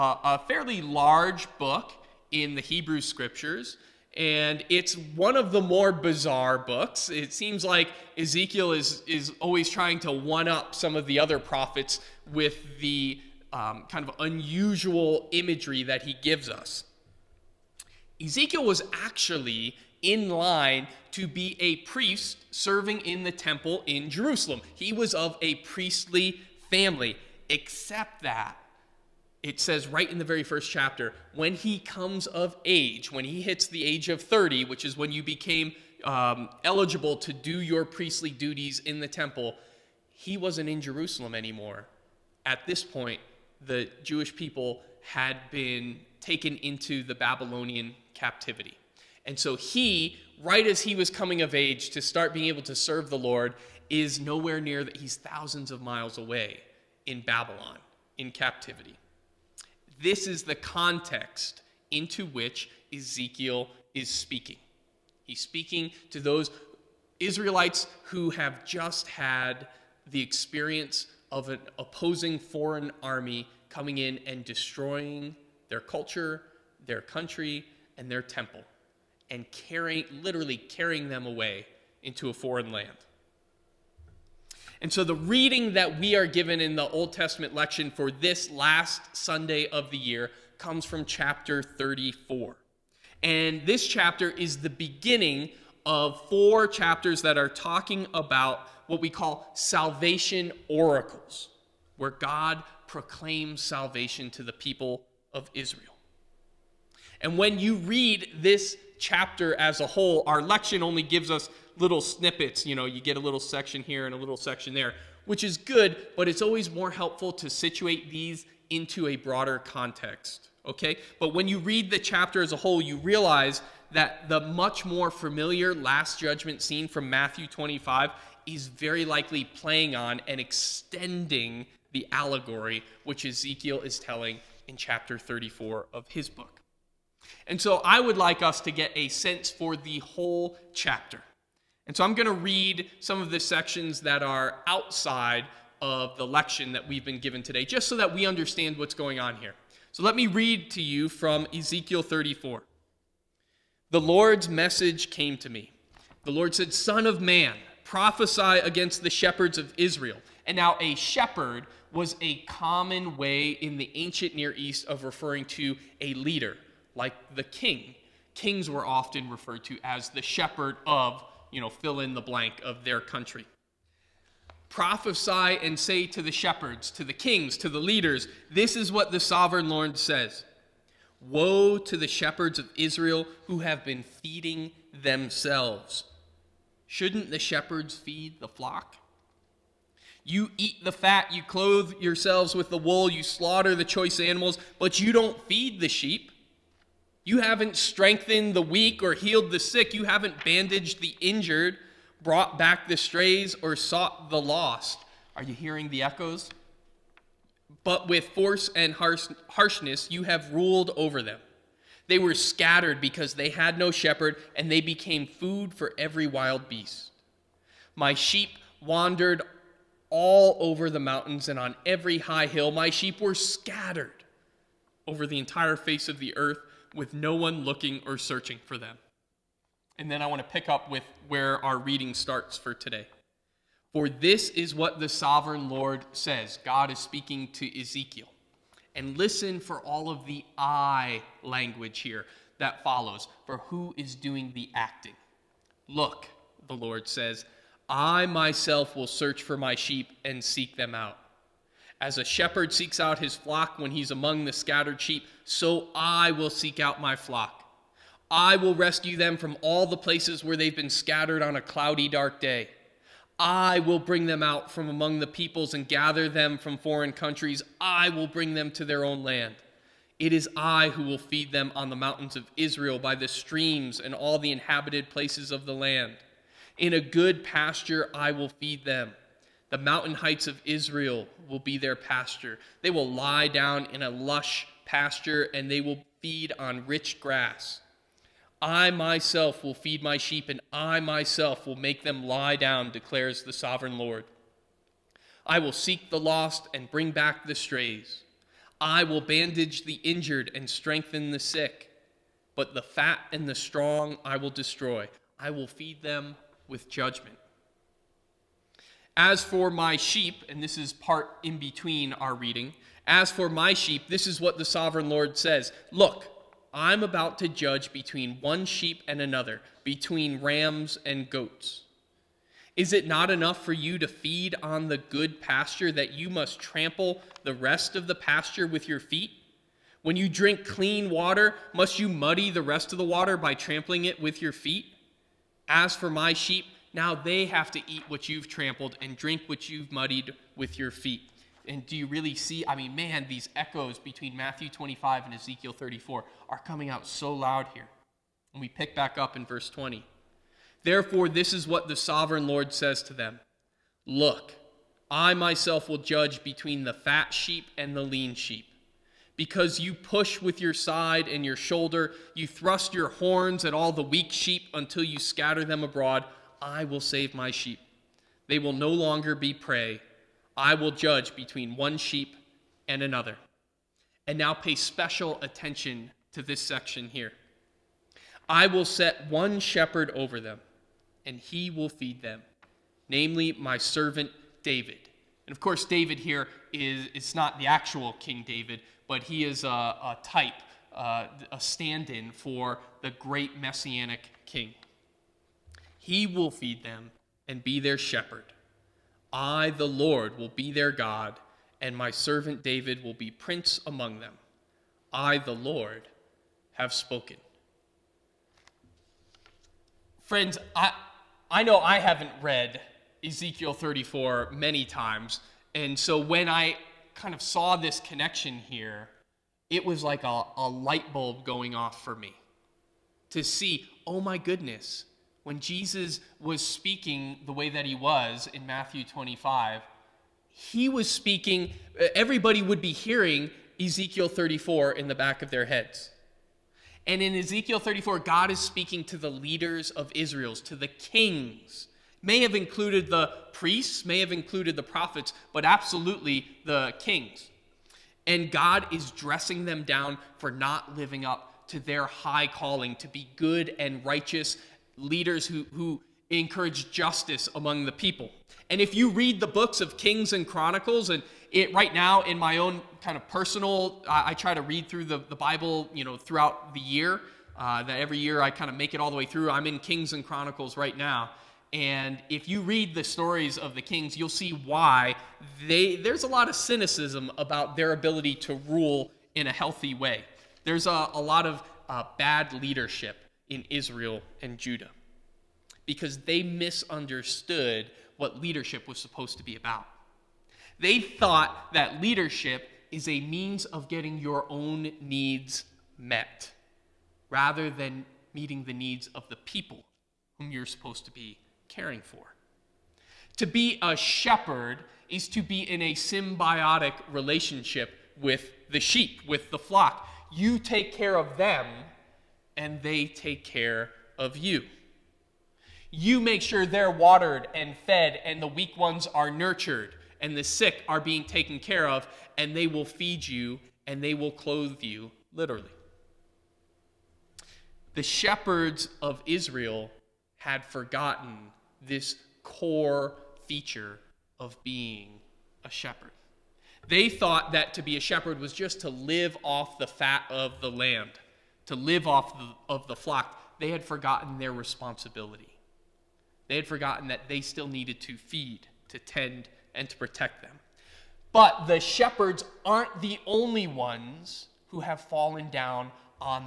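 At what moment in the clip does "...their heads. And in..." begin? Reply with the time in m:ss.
7:15.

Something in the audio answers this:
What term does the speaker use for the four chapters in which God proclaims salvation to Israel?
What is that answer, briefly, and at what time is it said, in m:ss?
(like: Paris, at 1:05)
Salvation oracles, at 1:39.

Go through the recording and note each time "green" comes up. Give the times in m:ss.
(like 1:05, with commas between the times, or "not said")
not said.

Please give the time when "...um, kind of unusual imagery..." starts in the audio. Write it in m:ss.
0:13.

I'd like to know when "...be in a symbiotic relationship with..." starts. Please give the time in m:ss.
8:25.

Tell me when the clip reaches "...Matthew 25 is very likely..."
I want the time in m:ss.
2:07.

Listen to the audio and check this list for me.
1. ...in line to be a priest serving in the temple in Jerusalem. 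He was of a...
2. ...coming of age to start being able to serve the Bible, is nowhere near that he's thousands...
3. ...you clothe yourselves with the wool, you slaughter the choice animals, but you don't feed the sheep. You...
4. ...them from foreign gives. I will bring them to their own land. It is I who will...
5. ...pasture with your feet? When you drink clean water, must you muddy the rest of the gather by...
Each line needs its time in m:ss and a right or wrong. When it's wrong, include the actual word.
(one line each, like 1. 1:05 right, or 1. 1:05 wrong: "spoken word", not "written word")
1. 0:20 right
2. 0:51 wrong: "Lord", not "Bible"
3. 3:11 right
4. 4:26 wrong: "countries", not "gives"
5. 5:28 wrong: "water", not "gather".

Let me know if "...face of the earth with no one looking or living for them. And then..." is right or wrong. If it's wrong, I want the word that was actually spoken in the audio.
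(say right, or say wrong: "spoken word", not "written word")
wrong: "searching", not "living".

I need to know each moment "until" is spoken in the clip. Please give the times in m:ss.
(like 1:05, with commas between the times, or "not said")
6:04.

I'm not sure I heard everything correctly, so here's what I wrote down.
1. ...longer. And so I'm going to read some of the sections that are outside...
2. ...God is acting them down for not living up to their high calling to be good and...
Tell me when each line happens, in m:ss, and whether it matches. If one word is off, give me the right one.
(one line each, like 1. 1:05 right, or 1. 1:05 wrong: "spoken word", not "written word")
1. 2:20 wrong: "chapter", not "longer"
2. 7:28 wrong: "dressing", not "acting".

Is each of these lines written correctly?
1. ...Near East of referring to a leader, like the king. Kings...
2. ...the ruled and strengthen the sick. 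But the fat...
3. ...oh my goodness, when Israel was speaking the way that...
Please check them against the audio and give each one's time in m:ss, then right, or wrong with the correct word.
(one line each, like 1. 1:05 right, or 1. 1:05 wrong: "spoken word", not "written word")
1. 2:44 right
2. 4:59 wrong: "injured", not "ruled"
3. 7:04 wrong: "Jesus", not "Israel".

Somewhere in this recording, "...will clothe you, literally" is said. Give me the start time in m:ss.
8:44.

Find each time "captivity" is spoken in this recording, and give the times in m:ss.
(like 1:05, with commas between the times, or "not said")
0:48, 0:58.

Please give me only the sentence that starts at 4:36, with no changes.
In a good pasture I will feed them the mountain heights of Israel will be their pasture.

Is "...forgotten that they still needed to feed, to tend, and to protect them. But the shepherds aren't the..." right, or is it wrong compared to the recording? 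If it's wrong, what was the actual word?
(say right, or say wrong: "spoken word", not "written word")
right.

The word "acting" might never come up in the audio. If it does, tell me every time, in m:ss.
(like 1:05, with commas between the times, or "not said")
4:04.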